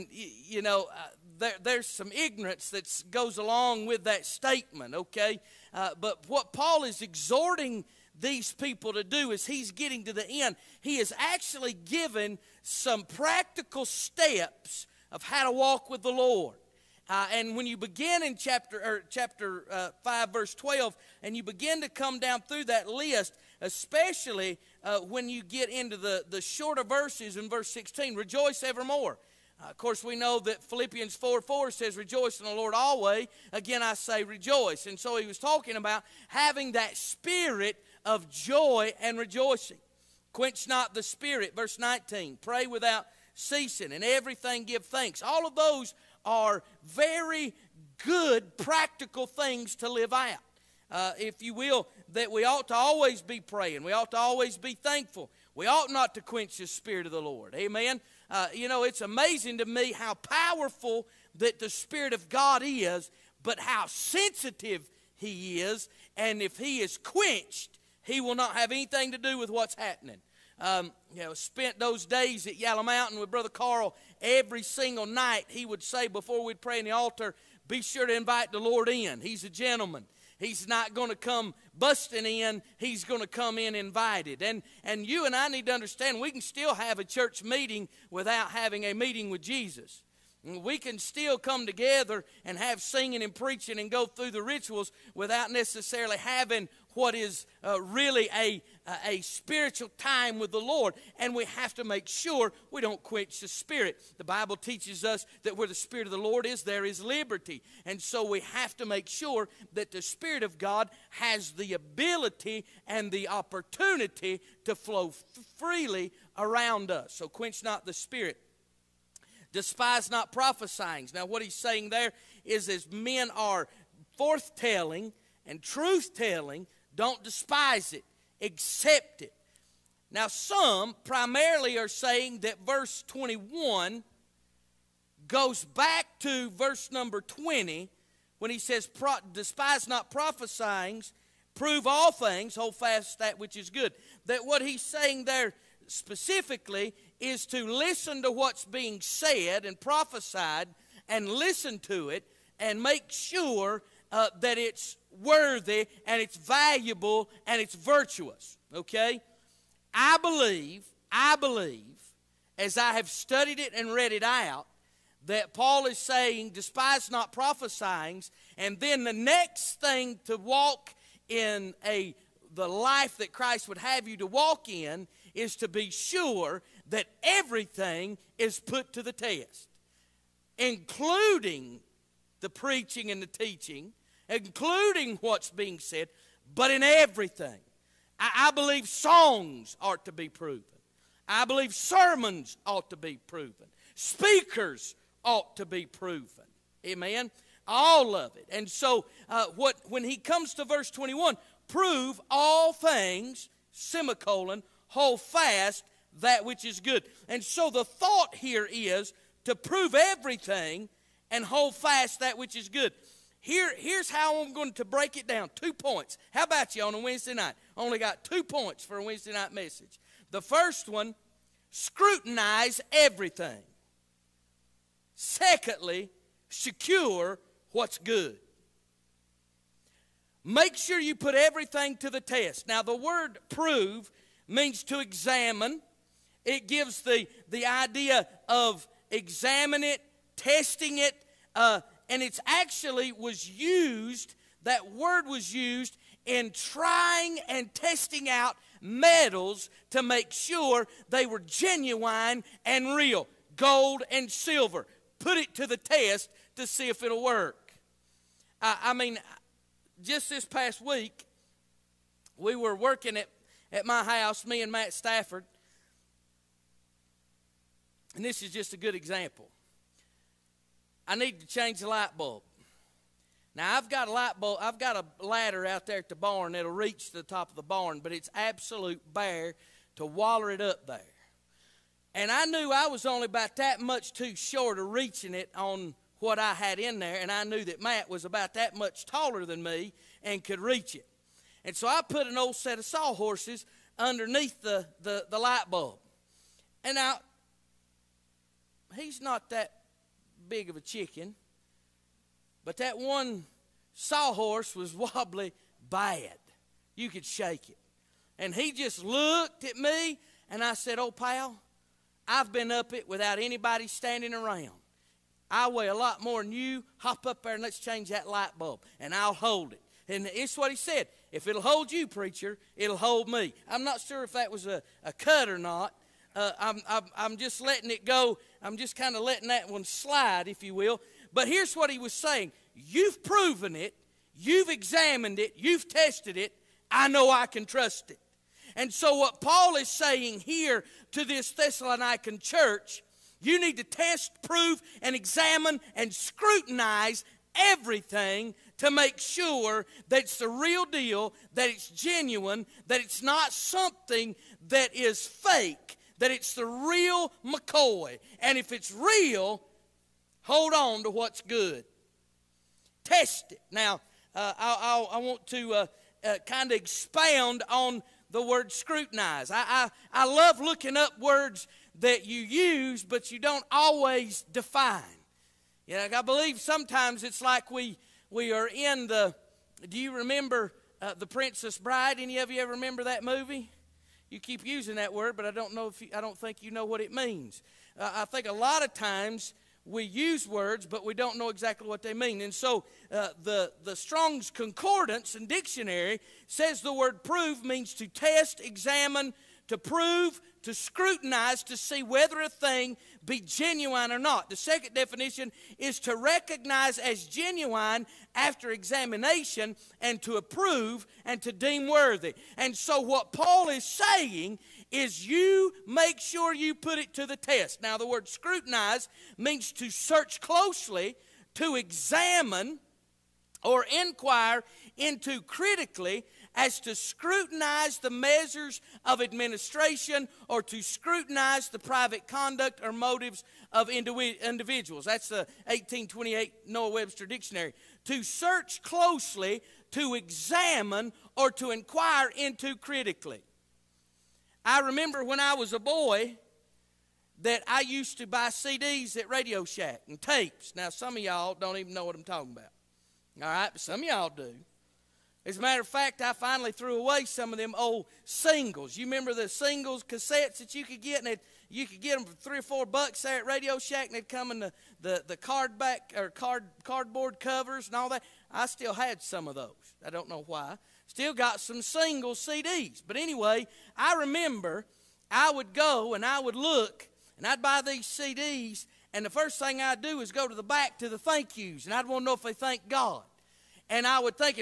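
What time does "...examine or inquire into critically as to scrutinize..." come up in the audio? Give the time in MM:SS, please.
07:01.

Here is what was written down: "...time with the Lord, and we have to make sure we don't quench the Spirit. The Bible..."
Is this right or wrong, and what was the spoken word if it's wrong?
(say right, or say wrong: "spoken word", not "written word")
right.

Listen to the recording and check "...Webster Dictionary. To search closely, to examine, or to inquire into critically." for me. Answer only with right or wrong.
right.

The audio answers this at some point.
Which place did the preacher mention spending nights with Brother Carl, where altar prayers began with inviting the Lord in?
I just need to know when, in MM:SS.
01:12.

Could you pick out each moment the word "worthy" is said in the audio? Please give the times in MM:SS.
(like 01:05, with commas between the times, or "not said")
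02:35, 06:51.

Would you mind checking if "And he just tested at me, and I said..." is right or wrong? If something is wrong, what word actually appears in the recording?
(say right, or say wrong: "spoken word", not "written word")
wrong: "looked", not "tested".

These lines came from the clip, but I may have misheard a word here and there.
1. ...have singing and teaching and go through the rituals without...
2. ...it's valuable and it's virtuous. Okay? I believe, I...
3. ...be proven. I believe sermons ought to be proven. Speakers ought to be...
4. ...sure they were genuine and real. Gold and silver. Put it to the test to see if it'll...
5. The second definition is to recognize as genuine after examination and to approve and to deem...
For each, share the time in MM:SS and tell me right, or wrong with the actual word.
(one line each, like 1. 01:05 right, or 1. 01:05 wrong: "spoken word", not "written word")
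1. 01:32 wrong: "preaching", not "teaching"
2. 02:36 right
3. 03:10 right
4. 04:10 right
5. 06:44 right.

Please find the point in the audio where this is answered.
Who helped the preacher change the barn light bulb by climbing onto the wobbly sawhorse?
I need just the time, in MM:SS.
04:24.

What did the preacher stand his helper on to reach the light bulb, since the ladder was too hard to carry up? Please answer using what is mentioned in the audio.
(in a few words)
sawhorses.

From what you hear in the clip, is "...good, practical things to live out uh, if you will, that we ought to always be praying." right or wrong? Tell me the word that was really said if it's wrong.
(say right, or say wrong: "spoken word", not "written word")
right.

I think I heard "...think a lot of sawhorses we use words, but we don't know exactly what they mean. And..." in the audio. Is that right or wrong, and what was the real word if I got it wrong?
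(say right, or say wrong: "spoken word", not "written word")
wrong: "times", not "sawhorses".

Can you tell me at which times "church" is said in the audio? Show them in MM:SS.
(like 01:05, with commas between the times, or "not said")
01:27, 05:42.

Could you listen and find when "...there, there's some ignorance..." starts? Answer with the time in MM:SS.
00:01.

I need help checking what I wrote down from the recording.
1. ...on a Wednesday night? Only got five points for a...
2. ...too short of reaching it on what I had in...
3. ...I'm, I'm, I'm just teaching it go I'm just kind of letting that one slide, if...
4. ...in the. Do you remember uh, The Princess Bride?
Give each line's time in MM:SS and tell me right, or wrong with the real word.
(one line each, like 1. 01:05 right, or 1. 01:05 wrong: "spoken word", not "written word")
1. 03:36 wrong: "two", not "five"
2. 04:44 right
3. 05:26 wrong: "letting", not "teaching"
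4. 06:18 right.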